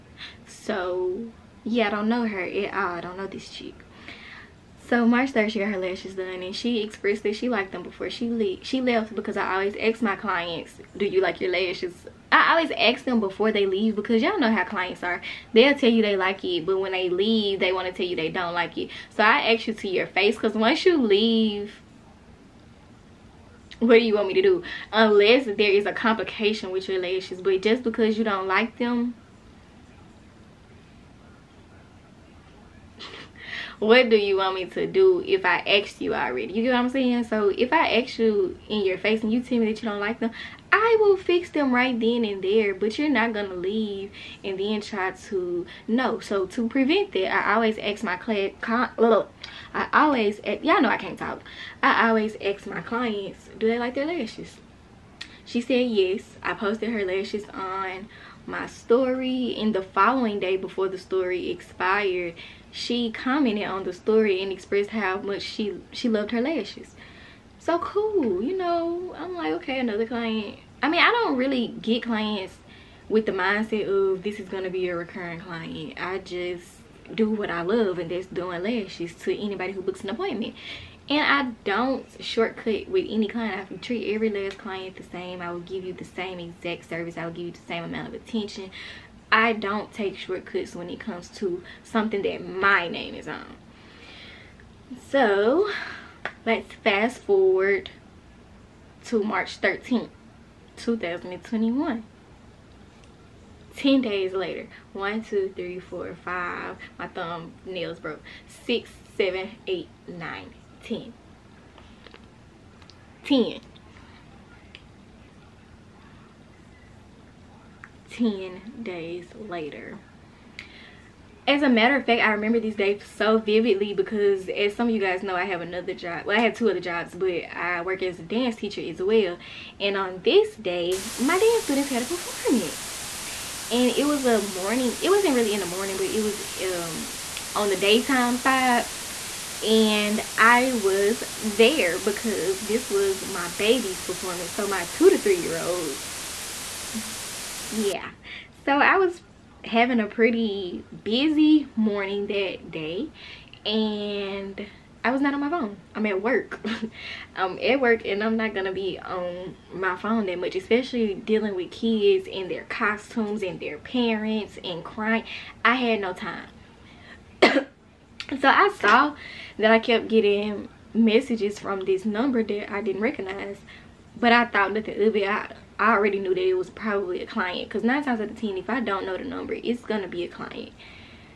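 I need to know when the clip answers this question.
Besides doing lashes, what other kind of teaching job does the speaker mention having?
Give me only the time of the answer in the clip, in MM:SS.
02:08.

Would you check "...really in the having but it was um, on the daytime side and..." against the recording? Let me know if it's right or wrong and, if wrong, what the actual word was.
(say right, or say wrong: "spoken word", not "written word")
wrong: "morning", not "having".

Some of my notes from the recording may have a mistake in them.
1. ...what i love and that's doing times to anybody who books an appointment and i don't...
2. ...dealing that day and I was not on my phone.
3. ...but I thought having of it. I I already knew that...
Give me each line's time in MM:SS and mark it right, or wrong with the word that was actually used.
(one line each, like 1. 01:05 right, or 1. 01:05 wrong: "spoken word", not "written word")
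1. 01:17 wrong: "lashes", not "times"
2. 02:31 wrong: "morning", not "dealing"
3. 02:54 wrong: "nothing", not "having".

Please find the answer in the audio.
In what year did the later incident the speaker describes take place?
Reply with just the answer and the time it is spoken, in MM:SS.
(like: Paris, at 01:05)
2021, at 01:40.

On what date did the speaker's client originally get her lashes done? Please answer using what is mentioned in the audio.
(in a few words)
March 3rd.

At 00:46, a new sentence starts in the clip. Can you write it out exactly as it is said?
So to prevent that, I always ask my client.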